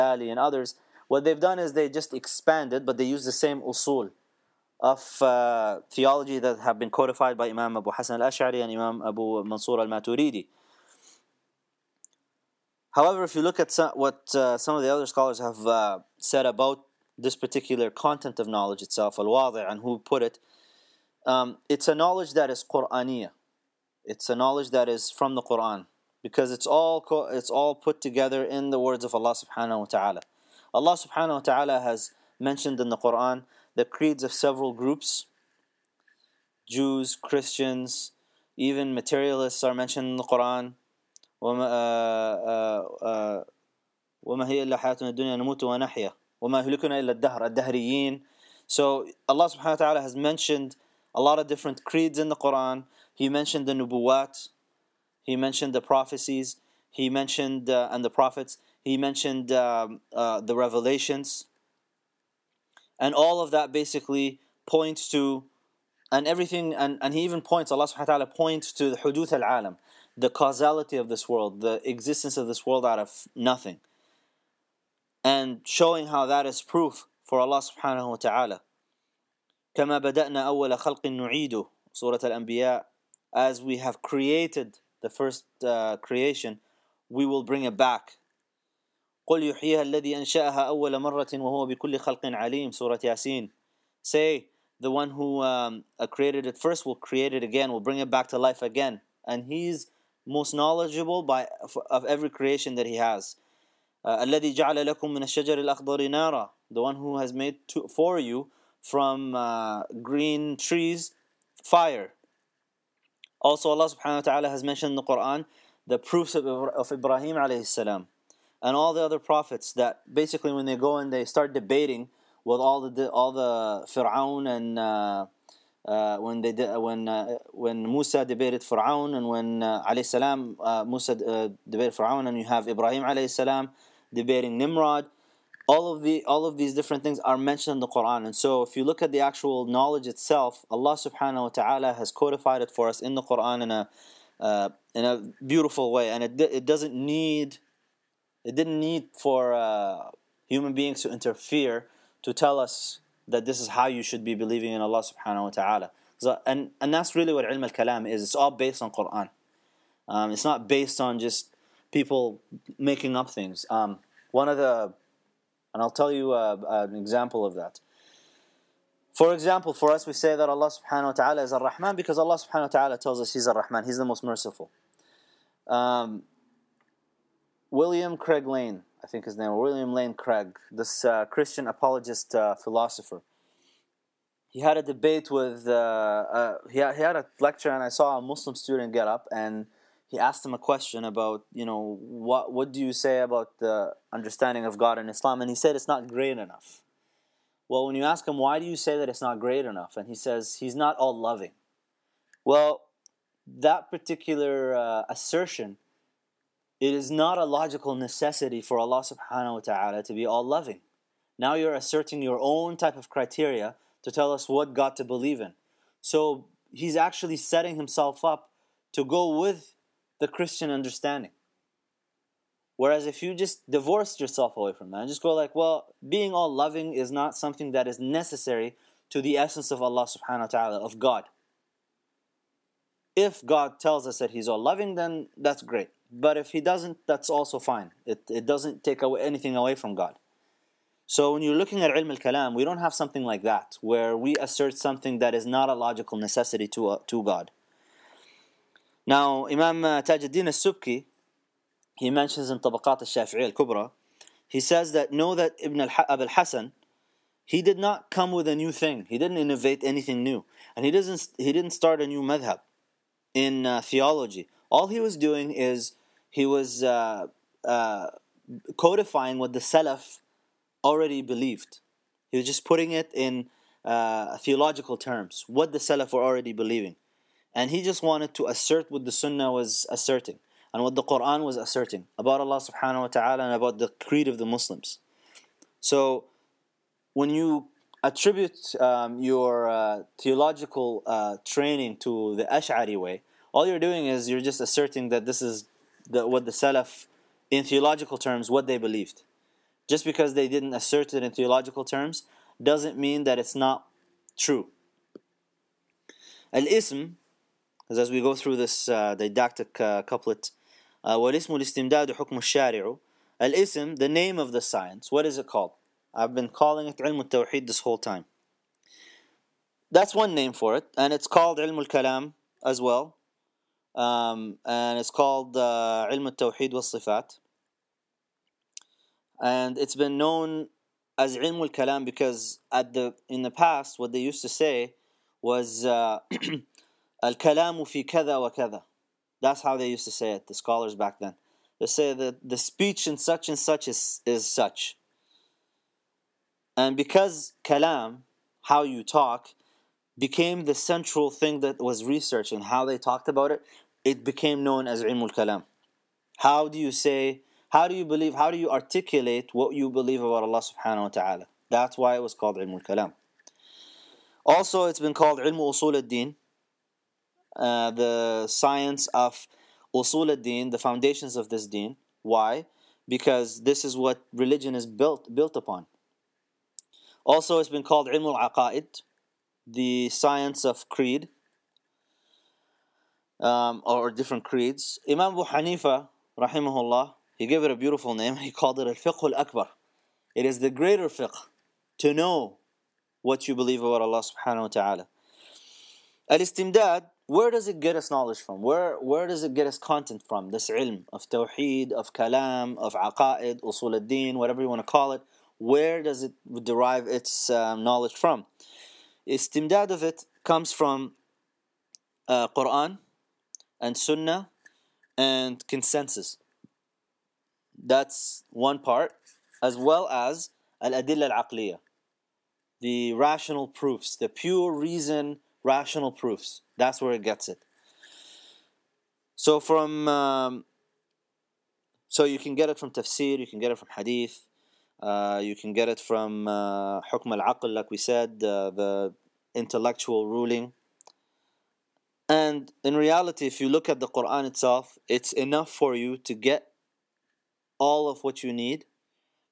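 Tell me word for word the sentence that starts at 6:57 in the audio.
That's one part, as well as al-adilla al-aqliya, the rational proofs, the pure reason rational proofs.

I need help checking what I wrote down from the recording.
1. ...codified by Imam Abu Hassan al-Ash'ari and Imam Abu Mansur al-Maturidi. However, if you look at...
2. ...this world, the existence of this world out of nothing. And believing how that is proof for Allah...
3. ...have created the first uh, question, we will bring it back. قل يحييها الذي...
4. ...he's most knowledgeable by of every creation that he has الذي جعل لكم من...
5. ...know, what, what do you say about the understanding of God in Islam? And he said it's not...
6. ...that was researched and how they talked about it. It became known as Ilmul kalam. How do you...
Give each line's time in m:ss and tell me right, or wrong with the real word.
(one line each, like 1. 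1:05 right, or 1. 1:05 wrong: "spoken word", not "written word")
1. 0:06 right
2. 1:11 wrong: "showing", not "believing"
3. 1:23 wrong: "creation", not "question"
4. 1:39 right
5. 3:11 right
6. 5:51 right.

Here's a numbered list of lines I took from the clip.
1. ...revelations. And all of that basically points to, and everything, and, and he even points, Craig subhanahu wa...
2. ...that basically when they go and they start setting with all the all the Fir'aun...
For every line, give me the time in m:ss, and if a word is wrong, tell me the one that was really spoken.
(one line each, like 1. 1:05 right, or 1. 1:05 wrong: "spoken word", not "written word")
1. 1:00 wrong: "Allah", not "Craig"
2. 1:59 wrong: "debating", not "setting".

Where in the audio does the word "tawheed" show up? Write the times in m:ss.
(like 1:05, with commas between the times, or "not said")
5:17, 6:41.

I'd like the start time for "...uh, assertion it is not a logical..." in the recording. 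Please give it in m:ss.
3:24.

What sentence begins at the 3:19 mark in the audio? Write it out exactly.
And he says, he's not all loving.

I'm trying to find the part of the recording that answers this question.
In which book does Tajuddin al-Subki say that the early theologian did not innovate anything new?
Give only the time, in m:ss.
4:12.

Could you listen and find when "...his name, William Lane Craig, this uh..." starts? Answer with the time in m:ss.
2:59.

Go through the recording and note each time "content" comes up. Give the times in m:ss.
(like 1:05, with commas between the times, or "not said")
0:17, 6:39.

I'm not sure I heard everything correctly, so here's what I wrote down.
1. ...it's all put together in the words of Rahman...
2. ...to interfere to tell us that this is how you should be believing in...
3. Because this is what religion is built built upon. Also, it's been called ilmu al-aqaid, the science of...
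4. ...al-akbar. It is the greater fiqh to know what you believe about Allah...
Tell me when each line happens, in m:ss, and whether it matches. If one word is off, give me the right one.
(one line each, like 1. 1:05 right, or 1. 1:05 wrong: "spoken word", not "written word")
1. 0:27 wrong: "Allah", not "Rahman"
2. 2:31 right
3. 6:13 right
4. 6:29 right.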